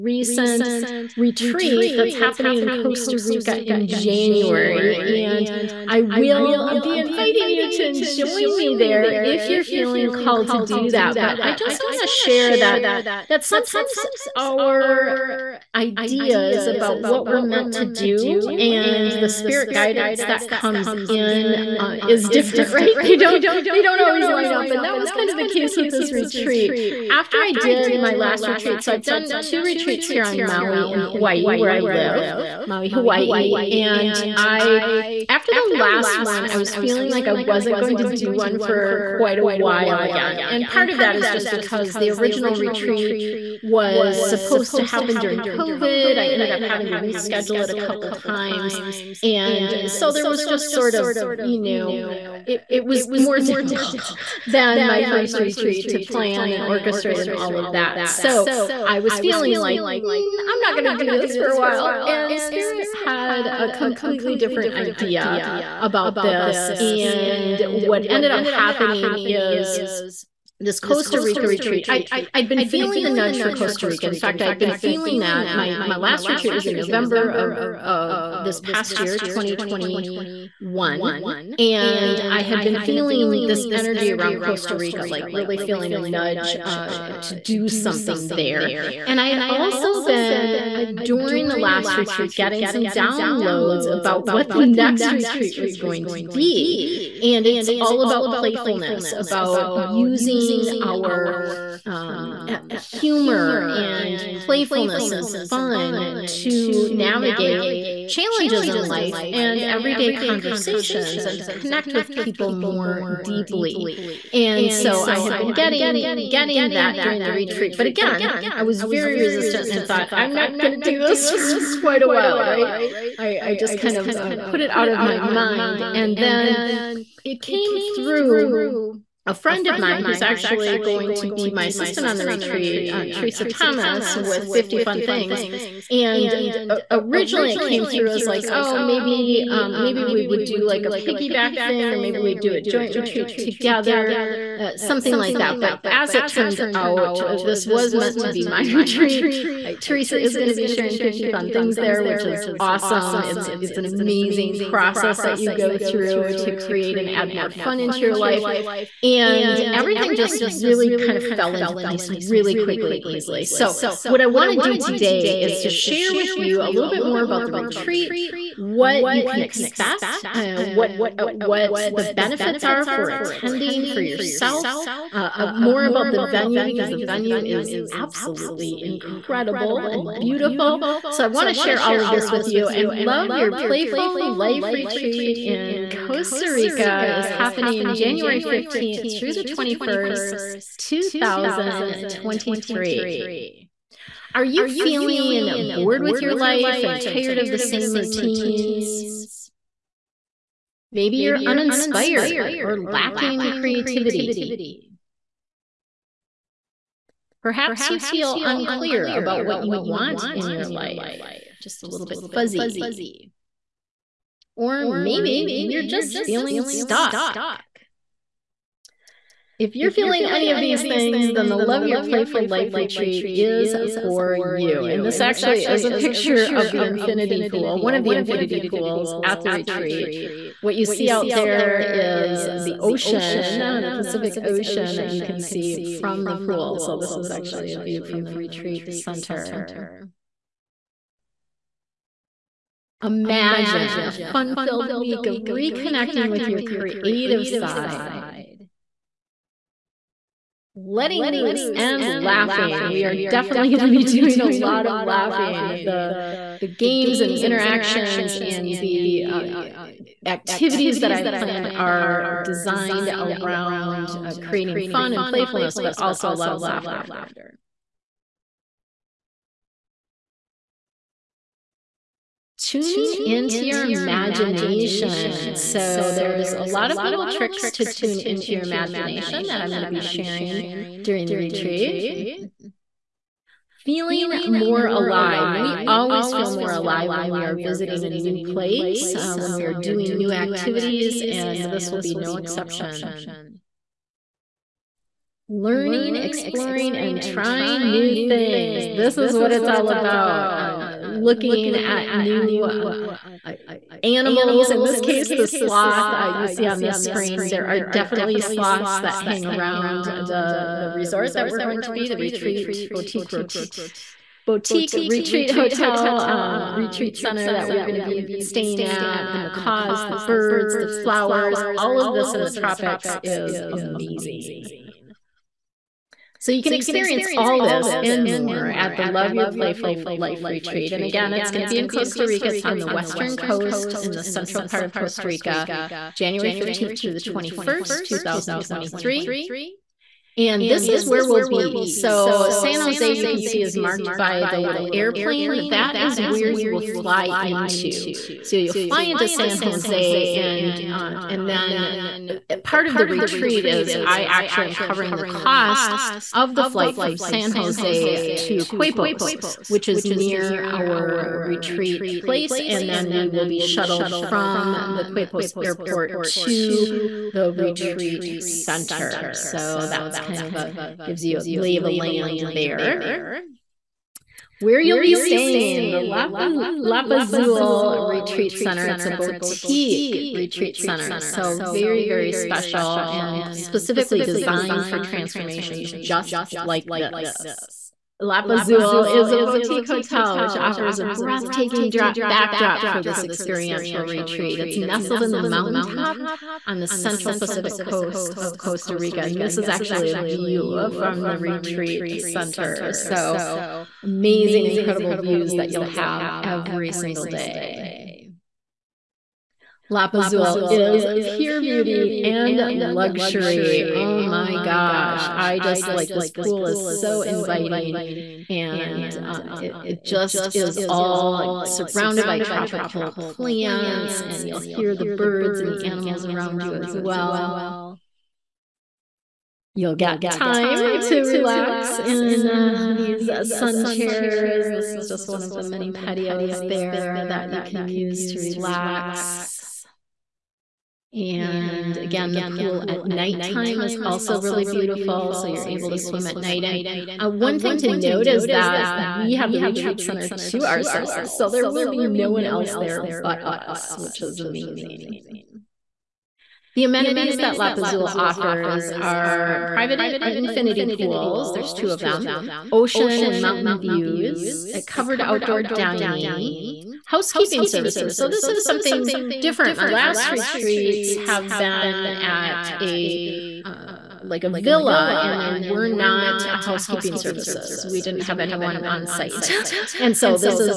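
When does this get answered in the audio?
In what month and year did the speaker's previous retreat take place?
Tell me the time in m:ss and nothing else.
1:16.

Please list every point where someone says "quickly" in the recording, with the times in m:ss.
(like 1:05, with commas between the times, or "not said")
2:42.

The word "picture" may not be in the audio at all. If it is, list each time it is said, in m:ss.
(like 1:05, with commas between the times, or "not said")
3:45.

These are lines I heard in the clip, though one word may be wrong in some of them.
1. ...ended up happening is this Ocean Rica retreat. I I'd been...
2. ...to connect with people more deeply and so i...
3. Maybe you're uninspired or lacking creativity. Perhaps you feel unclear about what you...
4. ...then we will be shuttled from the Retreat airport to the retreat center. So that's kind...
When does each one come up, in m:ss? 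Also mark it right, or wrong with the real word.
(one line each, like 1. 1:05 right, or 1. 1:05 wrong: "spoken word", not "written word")
1. 1:08 wrong: "Costa", not "Ocean"
2. 1:51 right
3. 3:20 right
4. 6:02 wrong: "Quepos", not "Retreat".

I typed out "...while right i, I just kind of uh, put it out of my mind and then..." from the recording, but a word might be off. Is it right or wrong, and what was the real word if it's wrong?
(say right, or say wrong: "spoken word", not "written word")
right.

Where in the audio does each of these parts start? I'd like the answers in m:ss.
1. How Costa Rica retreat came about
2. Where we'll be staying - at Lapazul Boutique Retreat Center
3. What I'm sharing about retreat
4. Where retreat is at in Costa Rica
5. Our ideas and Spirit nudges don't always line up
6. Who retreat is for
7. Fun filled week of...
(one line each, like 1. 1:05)
1. 1:06
2. 6:11
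3. 2:43
4. 5:30
5. 0:10
6. 3:13
7. 4:02.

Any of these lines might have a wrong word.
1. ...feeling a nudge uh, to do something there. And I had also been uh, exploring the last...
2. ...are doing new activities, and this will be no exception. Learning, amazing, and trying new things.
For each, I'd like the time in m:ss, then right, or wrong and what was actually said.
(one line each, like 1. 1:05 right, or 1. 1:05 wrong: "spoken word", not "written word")
1. 1:25 wrong: "during", not "exploring"
2. 4:49 wrong: "exploring", not "amazing".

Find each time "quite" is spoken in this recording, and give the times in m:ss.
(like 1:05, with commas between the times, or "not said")
0:39, 2:01.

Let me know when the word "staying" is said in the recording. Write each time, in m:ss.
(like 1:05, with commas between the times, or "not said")
5:18, 6:15.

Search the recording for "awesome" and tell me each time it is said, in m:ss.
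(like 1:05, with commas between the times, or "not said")
2:32.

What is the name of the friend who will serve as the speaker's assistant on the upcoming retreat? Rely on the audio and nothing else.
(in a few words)
Teresa Thomas.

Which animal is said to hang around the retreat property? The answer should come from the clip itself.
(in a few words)
sloth.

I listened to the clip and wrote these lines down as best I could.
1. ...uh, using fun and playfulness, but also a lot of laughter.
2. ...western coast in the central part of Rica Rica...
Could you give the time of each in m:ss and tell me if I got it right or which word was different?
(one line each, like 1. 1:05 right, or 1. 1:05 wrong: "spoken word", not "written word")
1. 4:24 wrong: "creating", not "using"
2. 5:32 wrong: "Costa", not "Rica".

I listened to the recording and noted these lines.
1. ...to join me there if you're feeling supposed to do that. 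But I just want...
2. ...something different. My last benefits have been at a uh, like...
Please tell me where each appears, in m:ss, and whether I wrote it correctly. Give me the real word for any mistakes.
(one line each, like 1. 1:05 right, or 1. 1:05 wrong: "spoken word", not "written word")
1. 0:07 wrong: "called", not "supposed"
2. 7:48 wrong: "retreats", not "benefits".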